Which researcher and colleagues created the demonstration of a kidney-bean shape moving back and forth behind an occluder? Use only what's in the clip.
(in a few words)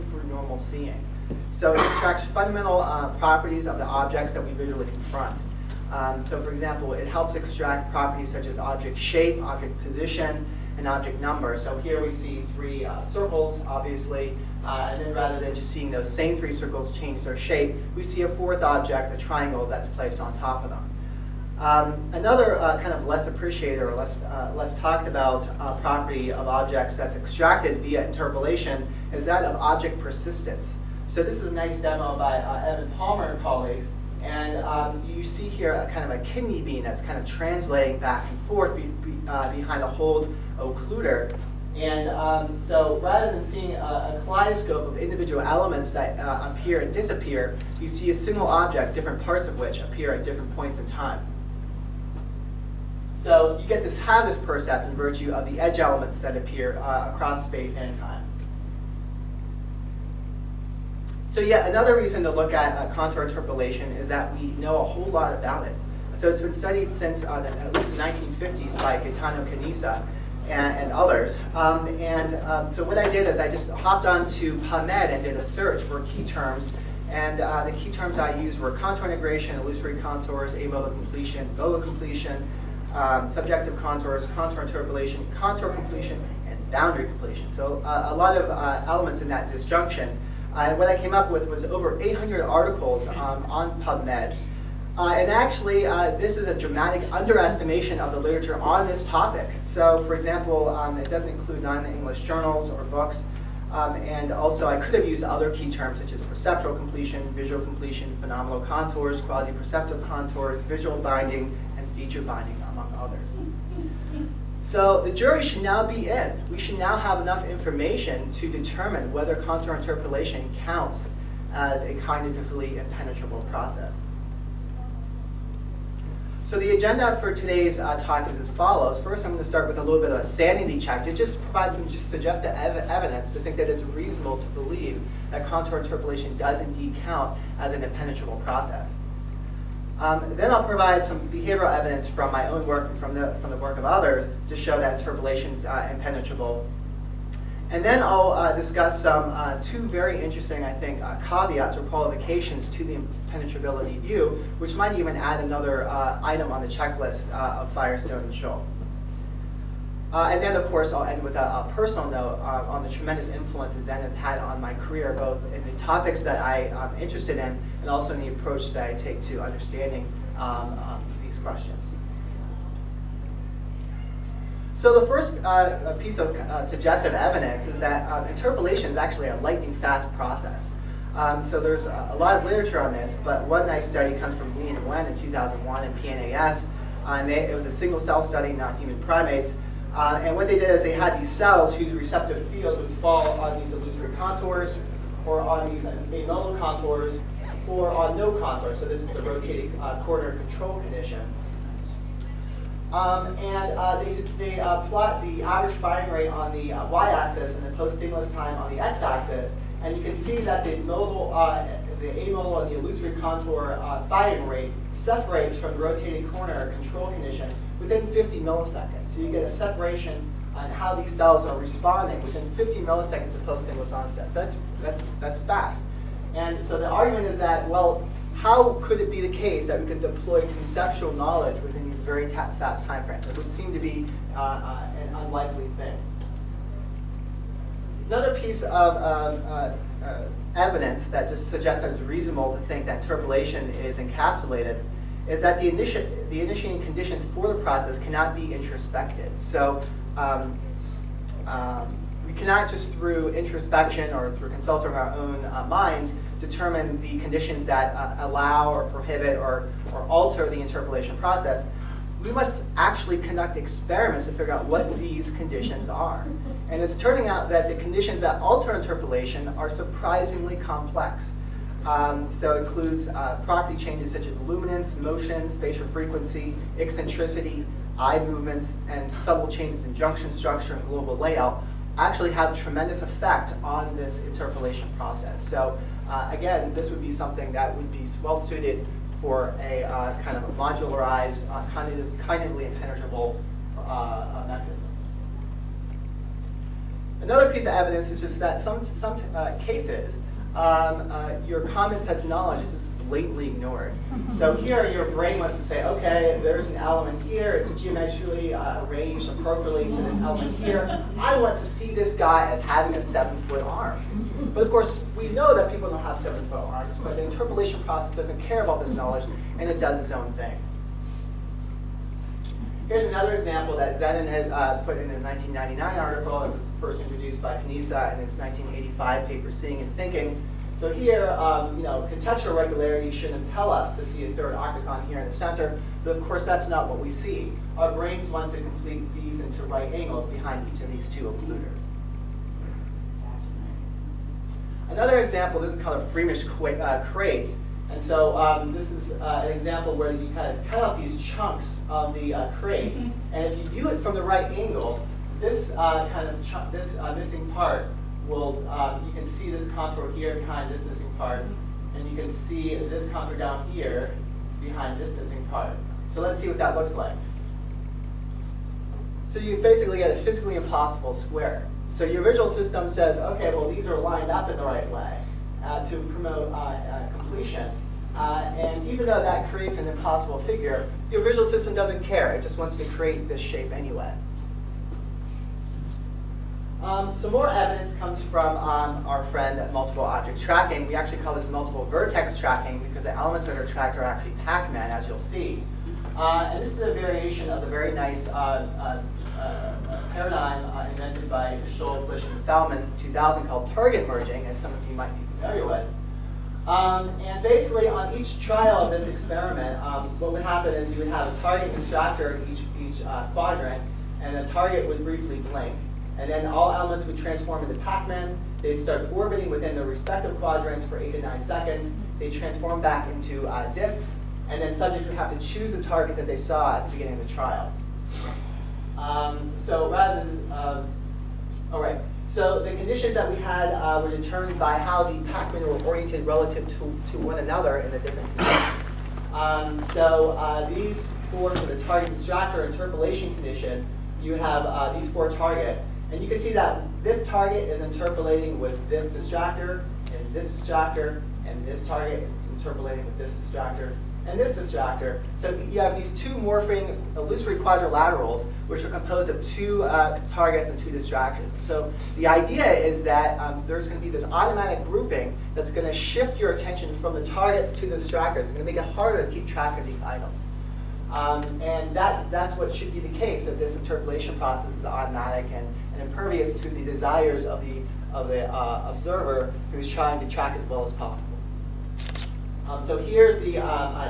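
Evan Palmer.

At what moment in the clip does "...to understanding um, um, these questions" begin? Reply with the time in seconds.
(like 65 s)
169 s.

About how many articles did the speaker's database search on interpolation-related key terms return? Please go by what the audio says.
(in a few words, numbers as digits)
Over 800.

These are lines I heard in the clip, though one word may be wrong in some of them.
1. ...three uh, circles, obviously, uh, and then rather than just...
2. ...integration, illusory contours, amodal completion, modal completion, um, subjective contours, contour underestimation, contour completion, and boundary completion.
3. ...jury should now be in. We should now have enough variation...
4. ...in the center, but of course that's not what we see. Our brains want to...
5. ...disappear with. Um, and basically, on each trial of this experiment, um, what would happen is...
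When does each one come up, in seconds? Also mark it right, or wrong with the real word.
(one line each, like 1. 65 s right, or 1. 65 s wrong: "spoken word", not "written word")
1. 12 s right
2. 79 s wrong: "interpolation", not "underestimation"
3. 115 s wrong: "information", not "variation"
4. 335 s right
5. 405 s wrong: "familiar", not "disappear".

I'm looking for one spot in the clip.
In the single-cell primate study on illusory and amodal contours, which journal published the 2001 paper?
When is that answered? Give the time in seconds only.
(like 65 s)
185 s.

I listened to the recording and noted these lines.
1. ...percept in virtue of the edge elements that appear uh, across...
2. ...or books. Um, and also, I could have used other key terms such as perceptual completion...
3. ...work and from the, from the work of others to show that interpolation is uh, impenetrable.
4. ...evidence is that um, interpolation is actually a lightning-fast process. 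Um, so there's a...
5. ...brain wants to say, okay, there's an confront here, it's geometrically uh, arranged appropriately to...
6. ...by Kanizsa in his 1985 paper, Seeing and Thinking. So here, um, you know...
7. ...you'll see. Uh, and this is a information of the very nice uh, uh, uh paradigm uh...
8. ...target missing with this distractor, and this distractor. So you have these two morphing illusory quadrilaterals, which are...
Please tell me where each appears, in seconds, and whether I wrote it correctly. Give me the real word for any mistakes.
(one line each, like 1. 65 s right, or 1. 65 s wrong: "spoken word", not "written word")
1. 54 s right
2. 102 s right
3. 142 s right
4. 177 s right
5. 305 s wrong: "element", not "confront"
6. 327 s right
7. 395 s wrong: "variation", not "information"
8. 451 s wrong: "interpolating", not "missing".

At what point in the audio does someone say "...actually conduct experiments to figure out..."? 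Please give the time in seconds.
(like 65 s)
262 s.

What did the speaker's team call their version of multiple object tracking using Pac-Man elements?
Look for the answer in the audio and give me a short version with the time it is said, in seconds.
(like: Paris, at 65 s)
Multiple vertex tracking, at 391 s.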